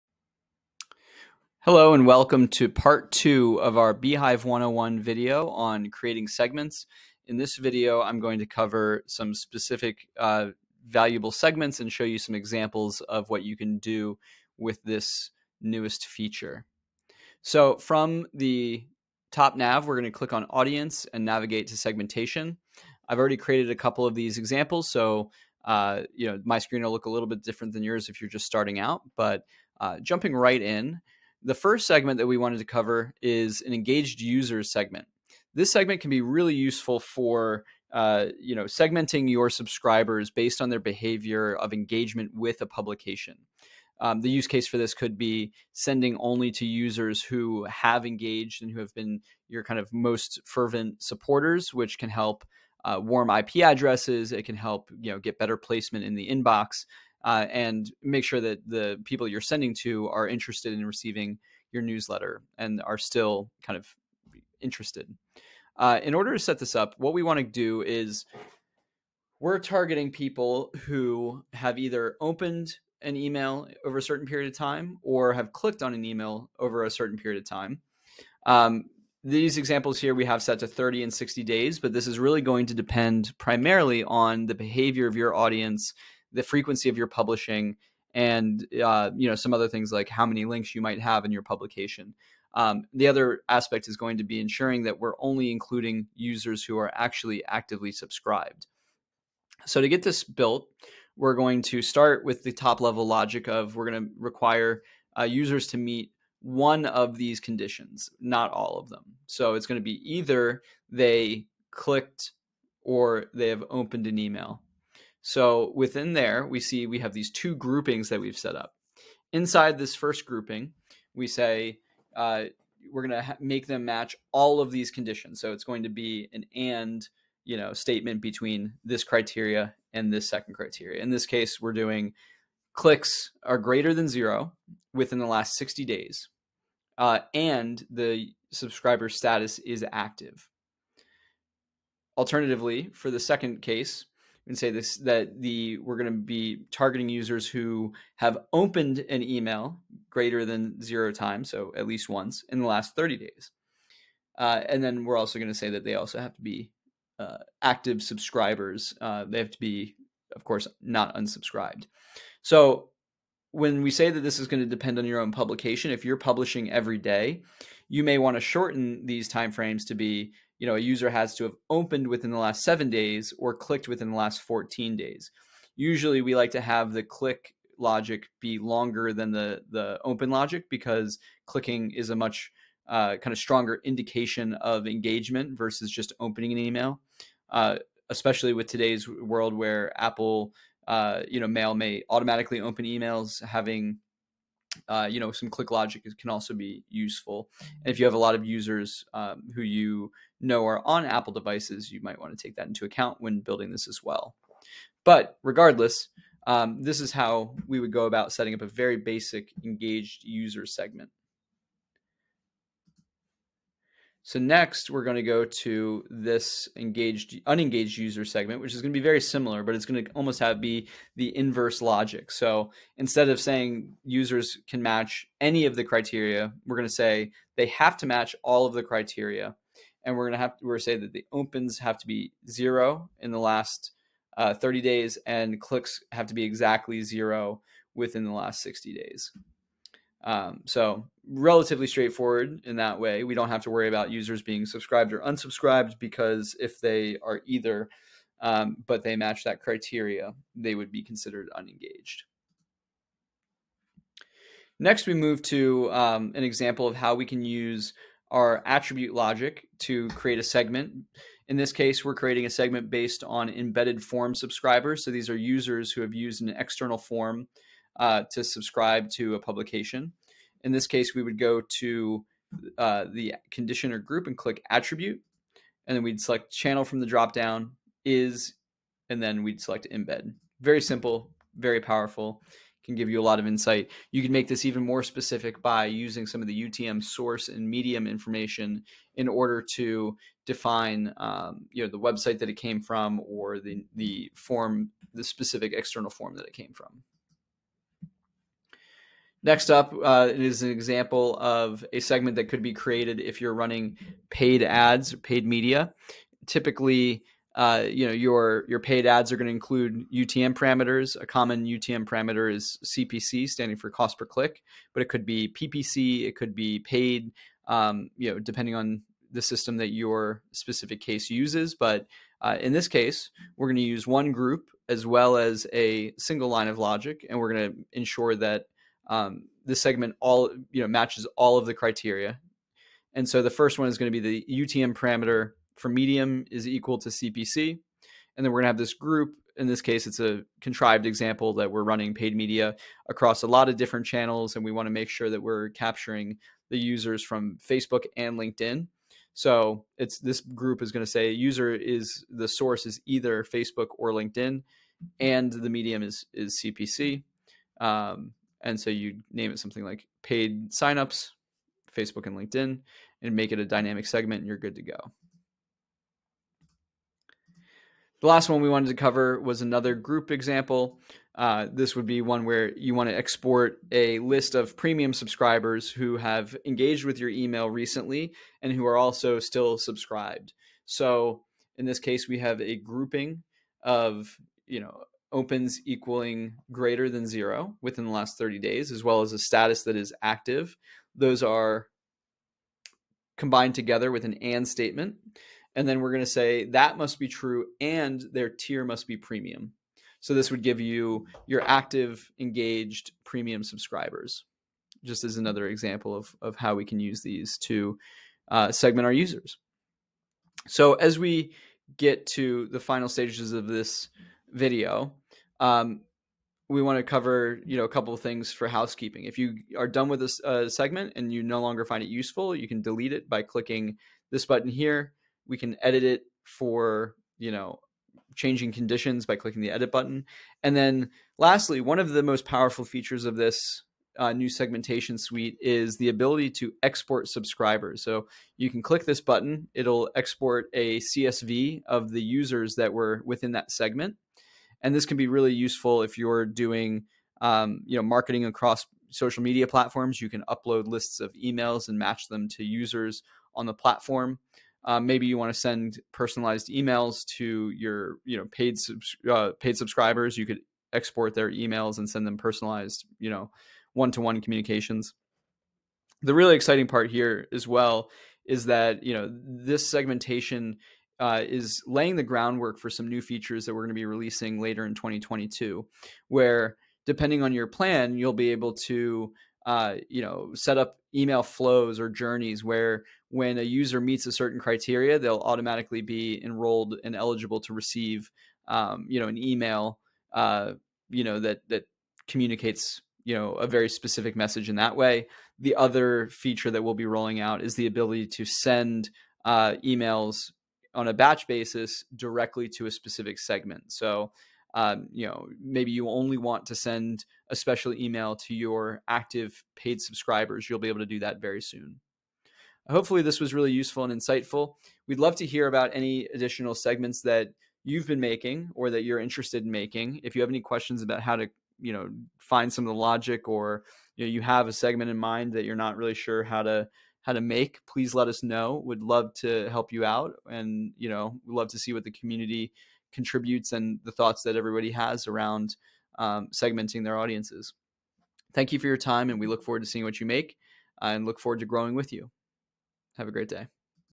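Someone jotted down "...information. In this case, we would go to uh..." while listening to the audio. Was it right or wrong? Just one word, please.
wrong.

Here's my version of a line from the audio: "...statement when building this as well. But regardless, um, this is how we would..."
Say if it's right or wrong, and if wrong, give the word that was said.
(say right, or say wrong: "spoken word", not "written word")
wrong: "account", not "statement".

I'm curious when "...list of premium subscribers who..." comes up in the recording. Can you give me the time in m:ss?
6:14.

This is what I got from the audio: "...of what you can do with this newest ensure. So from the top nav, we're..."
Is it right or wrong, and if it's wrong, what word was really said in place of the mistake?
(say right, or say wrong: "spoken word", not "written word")
wrong: "feature", not "ensure".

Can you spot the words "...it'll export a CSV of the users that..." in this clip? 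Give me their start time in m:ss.
7:19.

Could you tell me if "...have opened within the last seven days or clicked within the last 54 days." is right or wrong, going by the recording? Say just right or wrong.
wrong.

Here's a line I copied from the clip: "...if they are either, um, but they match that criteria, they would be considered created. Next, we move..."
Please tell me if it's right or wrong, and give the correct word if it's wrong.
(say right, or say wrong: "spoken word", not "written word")
wrong: "unengaged", not "created".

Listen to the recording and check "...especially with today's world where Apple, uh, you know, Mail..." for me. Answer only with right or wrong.
right.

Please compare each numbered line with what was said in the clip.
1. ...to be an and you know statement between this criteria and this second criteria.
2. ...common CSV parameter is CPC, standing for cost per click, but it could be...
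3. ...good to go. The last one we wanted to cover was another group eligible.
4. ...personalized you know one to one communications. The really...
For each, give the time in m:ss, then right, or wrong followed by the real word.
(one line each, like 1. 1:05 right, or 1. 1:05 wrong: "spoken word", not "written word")
1. 2:05 right
2. 5:11 wrong: "UTM", not "CSV"
3. 6:04 wrong: "example", not "eligible"
4. 7:42 right.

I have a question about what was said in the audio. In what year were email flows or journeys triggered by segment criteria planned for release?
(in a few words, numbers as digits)
2022.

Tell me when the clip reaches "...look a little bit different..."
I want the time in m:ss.
0:26.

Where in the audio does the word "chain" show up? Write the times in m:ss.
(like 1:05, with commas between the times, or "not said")
not said.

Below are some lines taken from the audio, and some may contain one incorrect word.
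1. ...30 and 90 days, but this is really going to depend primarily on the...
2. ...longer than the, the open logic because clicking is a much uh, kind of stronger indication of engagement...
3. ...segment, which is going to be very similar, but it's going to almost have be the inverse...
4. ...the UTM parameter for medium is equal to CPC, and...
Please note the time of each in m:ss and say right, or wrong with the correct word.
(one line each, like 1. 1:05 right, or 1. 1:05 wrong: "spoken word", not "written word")
1. 1:20 wrong: "60", not "90"
2. 2:58 right
3. 3:38 right
4. 5:34 right.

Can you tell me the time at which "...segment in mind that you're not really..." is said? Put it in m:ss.
8:44.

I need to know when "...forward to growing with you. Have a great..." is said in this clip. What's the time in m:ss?
9:01.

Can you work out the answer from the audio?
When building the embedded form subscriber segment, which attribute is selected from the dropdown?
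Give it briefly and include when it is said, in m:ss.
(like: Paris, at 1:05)
channel, at 4:36.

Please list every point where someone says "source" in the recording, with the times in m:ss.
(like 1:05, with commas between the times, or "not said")
4:47, 5:52.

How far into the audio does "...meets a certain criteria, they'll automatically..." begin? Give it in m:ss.
8:04.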